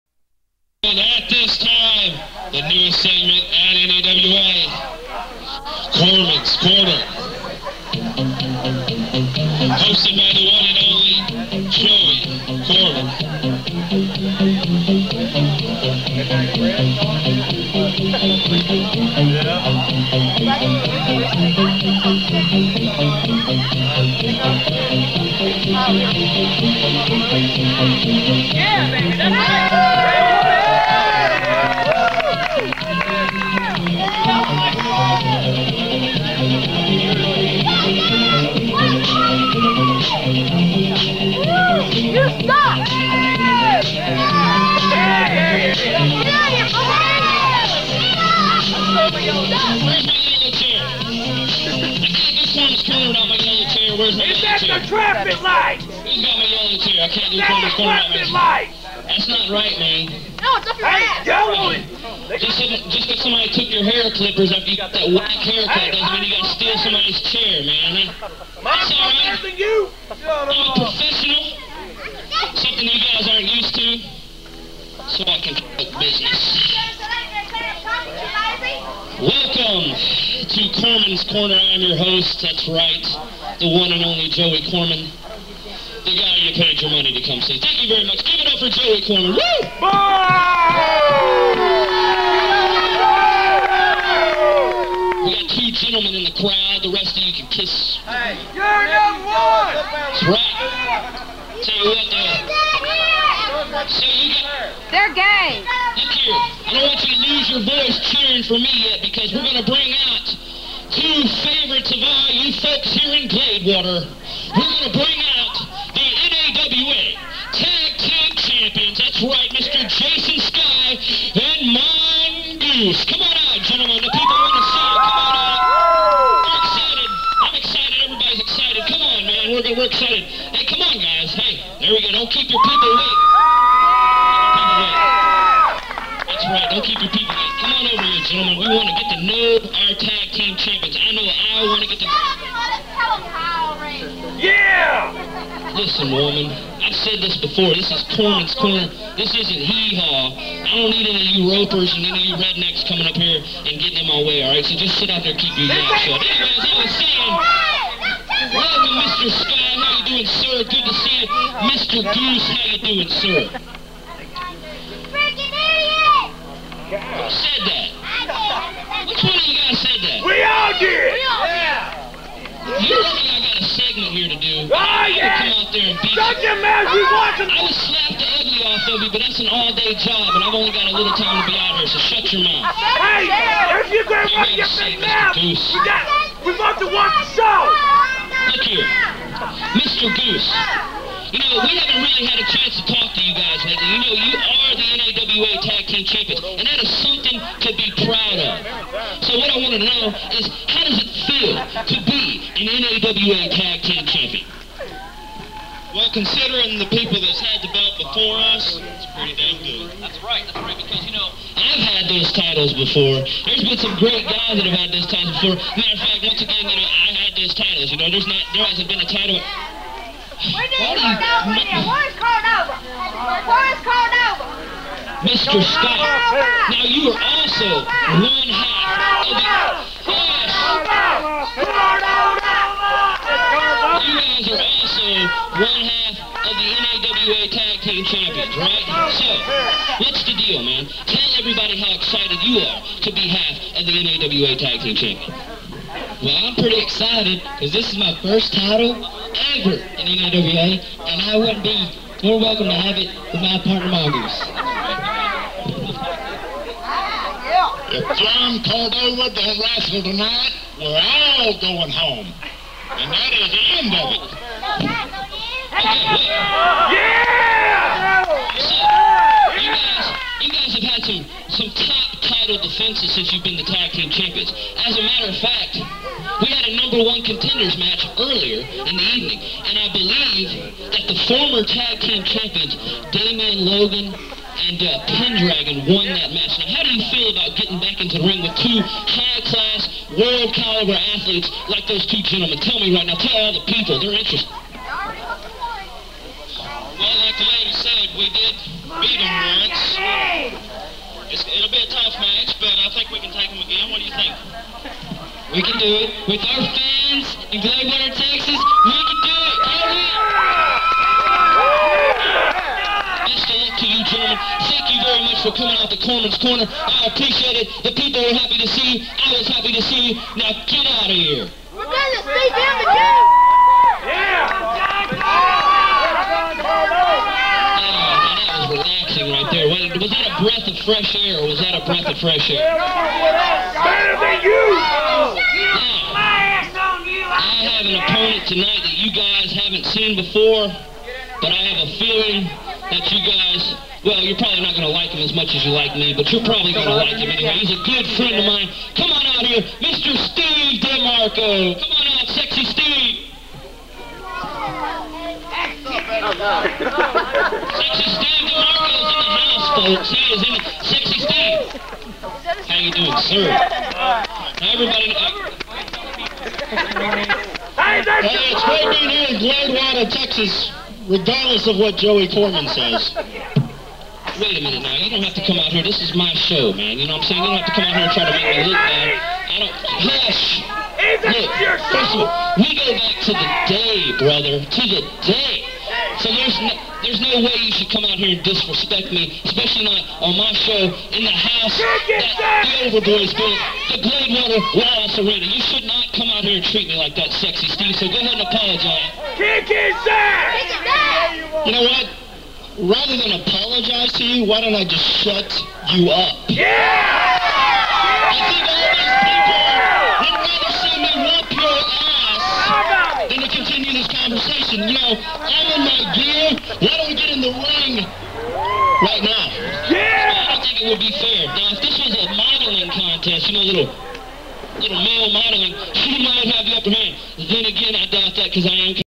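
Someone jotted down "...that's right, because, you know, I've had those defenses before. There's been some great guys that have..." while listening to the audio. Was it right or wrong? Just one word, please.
wrong.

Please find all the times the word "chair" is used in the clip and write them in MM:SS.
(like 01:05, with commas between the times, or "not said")
00:56, 01:07.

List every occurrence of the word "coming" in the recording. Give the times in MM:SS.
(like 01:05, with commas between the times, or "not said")
02:32, 05:15.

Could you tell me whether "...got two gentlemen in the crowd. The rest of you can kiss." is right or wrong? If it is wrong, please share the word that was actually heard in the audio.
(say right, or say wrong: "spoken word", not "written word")
right.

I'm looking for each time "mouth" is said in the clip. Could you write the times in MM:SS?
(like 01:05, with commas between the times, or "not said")
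02:35, 02:56, 03:02.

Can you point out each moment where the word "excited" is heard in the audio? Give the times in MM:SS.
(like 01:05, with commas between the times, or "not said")
04:01, 04:06.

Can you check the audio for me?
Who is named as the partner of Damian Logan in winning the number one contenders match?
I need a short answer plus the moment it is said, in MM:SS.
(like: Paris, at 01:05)
Pendragon, at 04:45.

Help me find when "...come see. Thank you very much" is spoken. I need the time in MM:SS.
01:27.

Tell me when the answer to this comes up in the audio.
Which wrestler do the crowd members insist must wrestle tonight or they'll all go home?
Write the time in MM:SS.
04:18.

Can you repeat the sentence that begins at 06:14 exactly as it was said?
Wait a minute now, you don't have to come out here.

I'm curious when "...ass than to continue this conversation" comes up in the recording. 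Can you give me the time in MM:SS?
06:52.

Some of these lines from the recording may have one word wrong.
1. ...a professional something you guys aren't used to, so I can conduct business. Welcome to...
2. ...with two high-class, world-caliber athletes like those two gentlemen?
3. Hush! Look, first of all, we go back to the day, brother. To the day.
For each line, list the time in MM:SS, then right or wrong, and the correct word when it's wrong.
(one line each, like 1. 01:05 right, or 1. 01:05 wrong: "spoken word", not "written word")
1. 01:10 right
2. 04:48 right
3. 06:20 right.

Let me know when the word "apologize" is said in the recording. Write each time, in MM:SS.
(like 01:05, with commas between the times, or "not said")
06:38, 06:43.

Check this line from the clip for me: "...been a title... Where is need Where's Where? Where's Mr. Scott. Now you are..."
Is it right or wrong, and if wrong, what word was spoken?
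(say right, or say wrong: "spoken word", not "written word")
wrong: "Cordova", not "Where".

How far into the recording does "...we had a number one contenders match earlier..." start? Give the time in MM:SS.
04:35.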